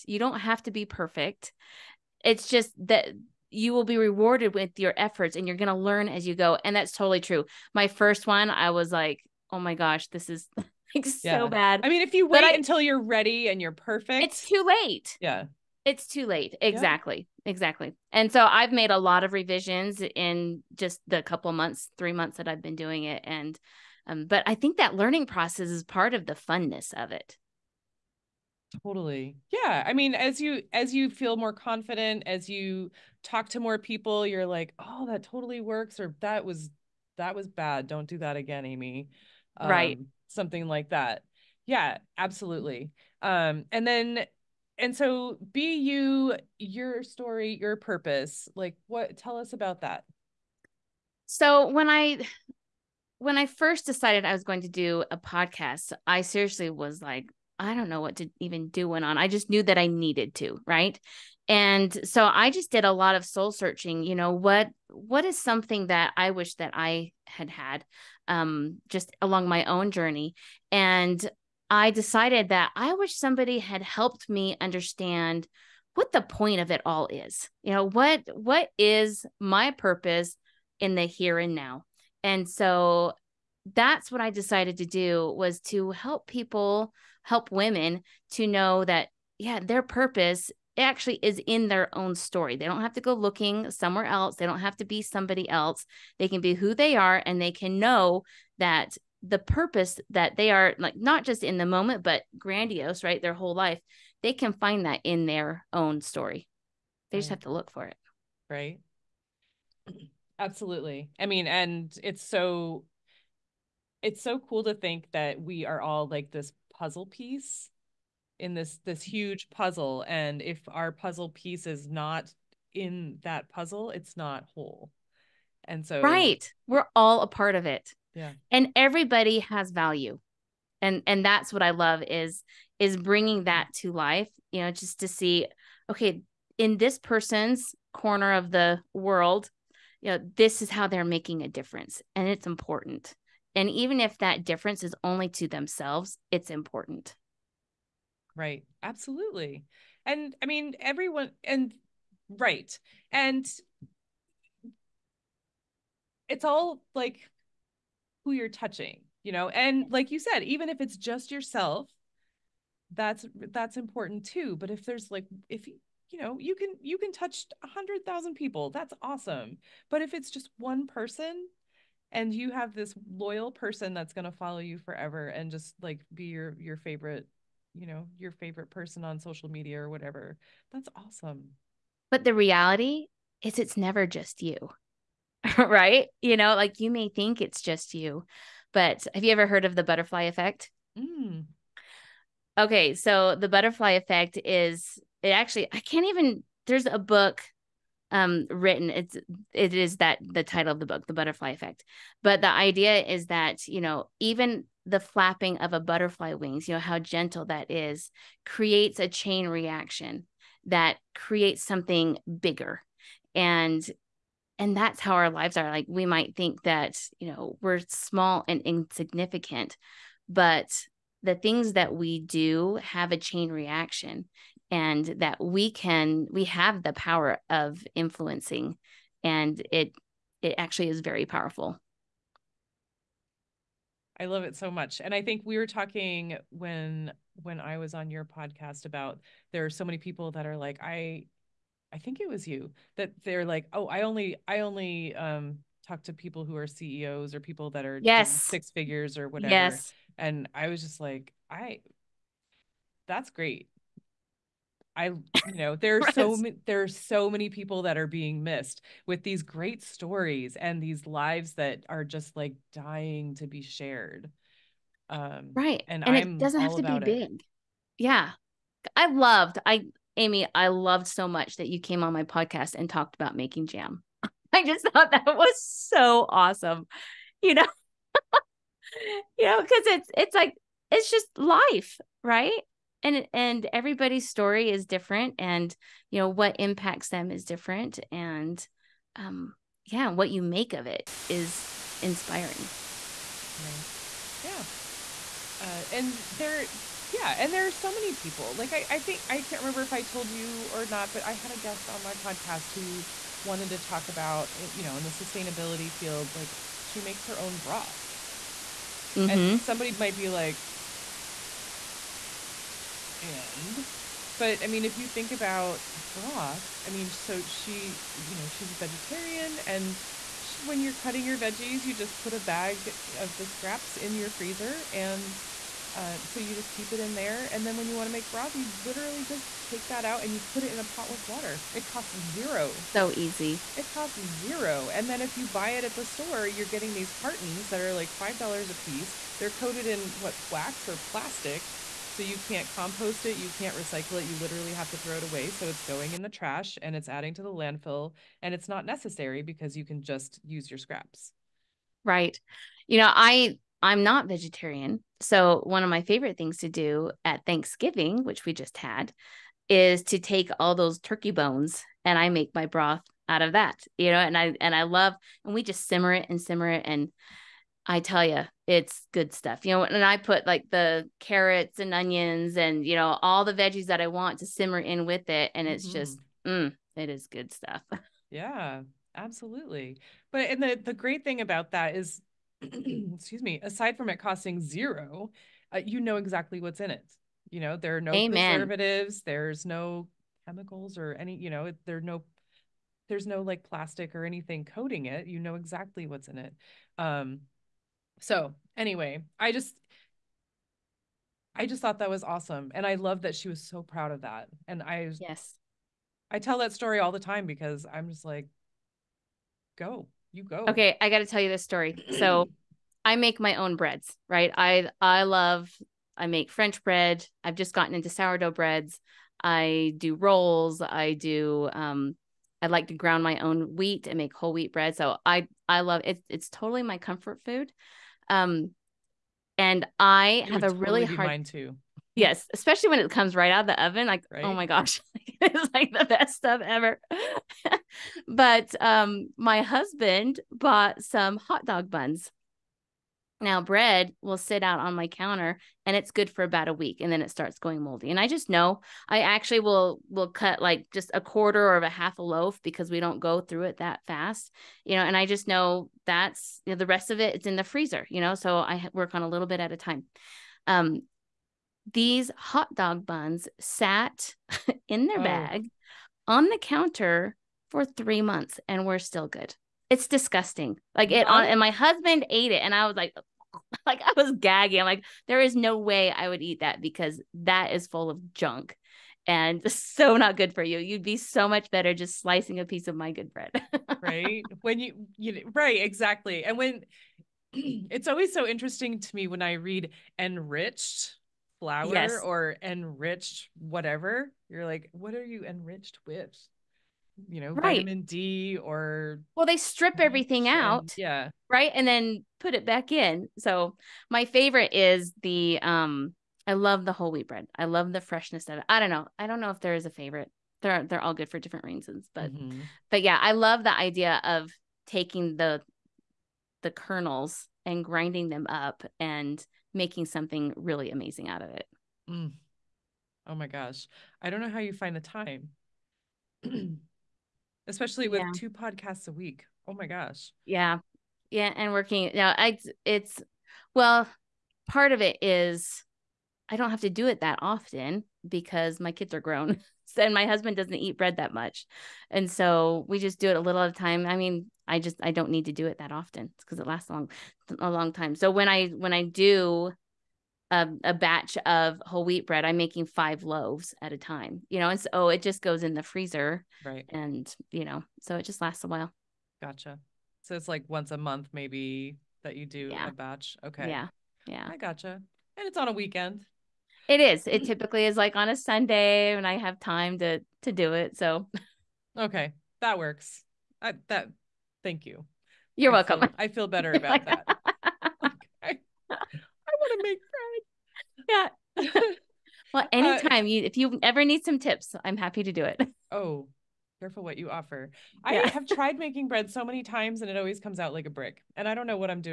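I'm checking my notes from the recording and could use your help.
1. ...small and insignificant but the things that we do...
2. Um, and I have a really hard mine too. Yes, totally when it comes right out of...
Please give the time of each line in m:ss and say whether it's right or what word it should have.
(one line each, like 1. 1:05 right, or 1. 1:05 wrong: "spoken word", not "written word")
1. 3:37 right
2. 7:08 wrong: "especially", not "totally".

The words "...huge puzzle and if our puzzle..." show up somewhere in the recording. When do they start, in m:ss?
1:59.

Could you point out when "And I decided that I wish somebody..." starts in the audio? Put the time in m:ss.
1:10.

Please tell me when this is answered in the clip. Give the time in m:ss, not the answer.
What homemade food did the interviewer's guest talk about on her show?
4:33.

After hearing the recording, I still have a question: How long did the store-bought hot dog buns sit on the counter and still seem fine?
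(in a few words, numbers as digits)
3 months.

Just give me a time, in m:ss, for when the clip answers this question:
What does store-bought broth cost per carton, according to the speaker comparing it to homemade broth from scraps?
5:38.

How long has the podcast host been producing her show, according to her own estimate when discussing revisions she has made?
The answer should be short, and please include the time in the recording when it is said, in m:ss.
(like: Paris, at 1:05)
3 months, at 0:21.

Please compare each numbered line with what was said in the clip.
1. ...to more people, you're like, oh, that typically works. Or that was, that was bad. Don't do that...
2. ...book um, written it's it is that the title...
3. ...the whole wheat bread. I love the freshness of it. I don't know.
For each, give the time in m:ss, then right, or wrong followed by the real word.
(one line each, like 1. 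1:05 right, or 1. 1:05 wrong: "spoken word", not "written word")
1. 0:33 wrong: "totally", not "typically"
2. 3:16 right
3. 8:26 right.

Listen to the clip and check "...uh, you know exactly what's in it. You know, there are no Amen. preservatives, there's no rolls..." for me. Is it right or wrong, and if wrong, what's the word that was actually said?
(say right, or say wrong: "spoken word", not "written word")
wrong: "chemicals", not "rolls".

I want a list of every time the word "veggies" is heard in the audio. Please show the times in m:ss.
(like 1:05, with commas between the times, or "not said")
5:21, 6:13.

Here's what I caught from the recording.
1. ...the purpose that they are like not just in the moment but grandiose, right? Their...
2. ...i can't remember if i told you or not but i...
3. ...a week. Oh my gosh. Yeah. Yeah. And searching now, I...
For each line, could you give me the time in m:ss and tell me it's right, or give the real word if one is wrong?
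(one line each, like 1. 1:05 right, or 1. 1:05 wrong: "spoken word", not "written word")
1. 1:39 right
2. 4:59 right
3. 8:49 wrong: "working", not "searching".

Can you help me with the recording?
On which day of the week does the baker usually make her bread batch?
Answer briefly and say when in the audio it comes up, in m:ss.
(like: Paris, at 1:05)
Sunday, at 9:28.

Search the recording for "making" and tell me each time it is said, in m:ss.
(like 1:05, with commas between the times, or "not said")
2:21, 4:33, 8:39, 9:12, 9:48.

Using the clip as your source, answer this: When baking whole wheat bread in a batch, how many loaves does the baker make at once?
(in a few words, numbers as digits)
5.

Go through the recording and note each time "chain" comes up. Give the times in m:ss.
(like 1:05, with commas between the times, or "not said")
3:29, 3:43.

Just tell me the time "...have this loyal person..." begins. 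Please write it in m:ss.
2:52.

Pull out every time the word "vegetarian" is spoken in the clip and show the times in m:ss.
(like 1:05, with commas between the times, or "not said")
5:18, 5:54.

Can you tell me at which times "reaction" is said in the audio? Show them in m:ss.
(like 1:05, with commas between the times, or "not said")
3:29, 3:43.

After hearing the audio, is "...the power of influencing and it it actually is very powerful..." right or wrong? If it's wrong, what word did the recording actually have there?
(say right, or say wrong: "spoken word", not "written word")
right.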